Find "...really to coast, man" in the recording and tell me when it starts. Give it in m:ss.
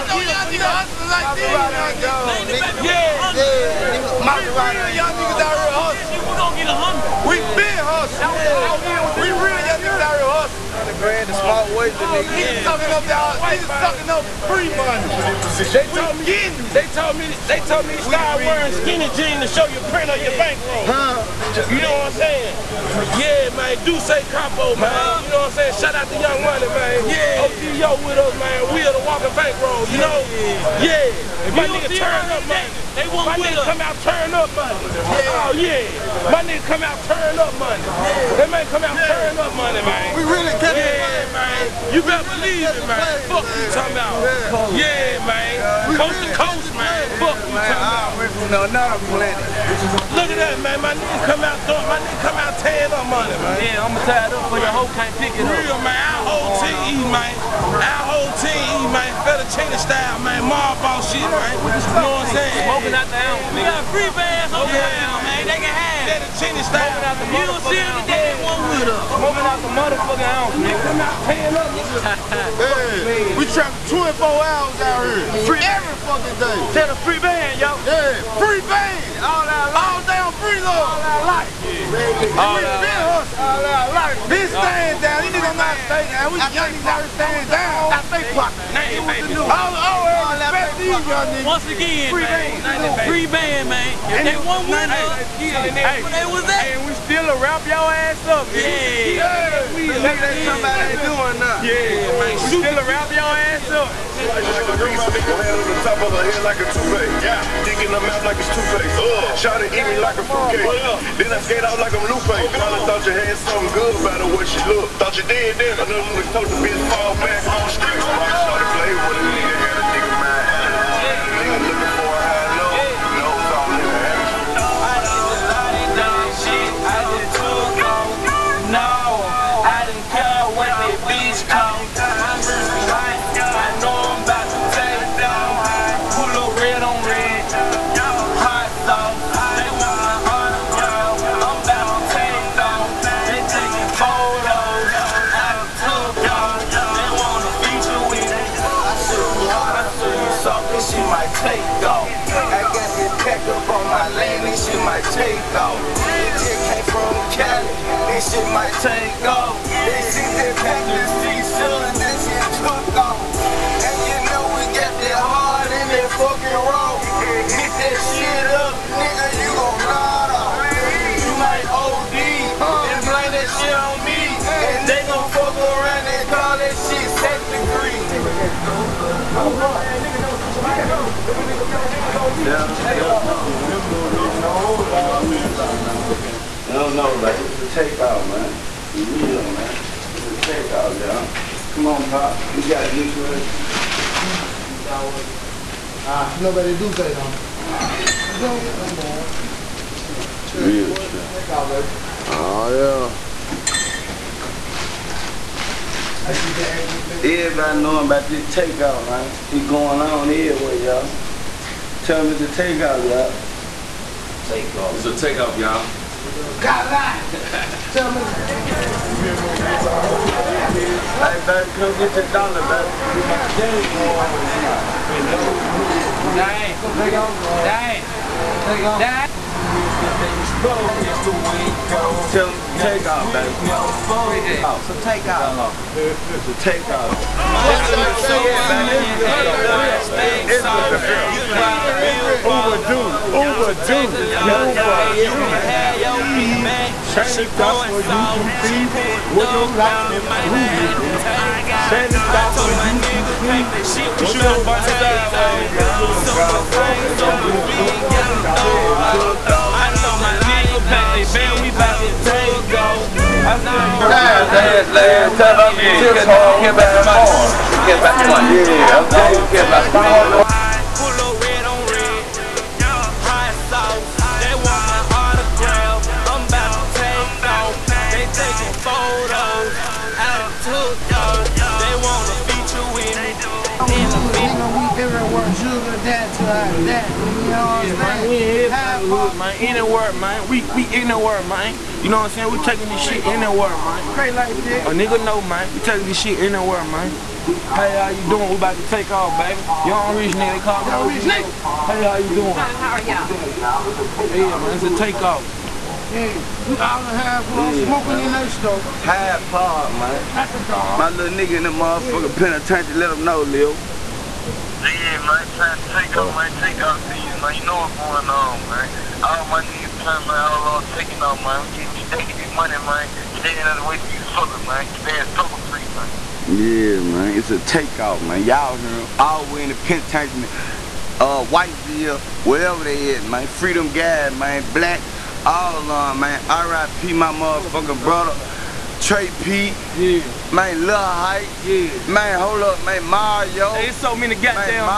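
0:46.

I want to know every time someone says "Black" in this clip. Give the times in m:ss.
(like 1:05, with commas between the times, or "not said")
5:34.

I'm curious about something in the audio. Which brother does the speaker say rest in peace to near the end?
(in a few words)
Trey Pete.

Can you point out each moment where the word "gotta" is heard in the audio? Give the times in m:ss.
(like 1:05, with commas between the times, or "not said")
3:12.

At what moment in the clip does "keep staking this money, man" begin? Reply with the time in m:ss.
5:21.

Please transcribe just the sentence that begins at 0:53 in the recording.
Yeah, I'm tied up for your hoe can't pick it up.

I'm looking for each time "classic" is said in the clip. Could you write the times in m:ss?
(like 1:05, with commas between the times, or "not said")
not said.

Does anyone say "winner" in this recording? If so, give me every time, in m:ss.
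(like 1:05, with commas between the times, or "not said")
1:34.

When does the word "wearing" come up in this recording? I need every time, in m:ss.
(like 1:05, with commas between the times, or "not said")
0:18.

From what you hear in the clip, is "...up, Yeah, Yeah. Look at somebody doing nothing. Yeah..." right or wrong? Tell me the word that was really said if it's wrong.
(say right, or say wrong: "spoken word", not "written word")
right.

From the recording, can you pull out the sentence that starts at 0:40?
We really catch yeah, play, man.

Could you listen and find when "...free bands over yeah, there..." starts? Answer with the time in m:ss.
1:03.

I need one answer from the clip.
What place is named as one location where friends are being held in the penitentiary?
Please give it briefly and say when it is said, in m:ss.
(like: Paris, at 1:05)
Whiteville, at 5:31.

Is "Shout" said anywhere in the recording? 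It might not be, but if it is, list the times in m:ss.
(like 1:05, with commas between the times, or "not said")
0:25, 1:49.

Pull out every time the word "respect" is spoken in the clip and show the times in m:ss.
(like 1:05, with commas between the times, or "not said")
1:30.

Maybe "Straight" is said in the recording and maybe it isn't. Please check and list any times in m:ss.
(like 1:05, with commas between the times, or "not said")
4:54.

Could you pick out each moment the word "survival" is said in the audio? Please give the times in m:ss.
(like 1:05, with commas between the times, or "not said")
not said.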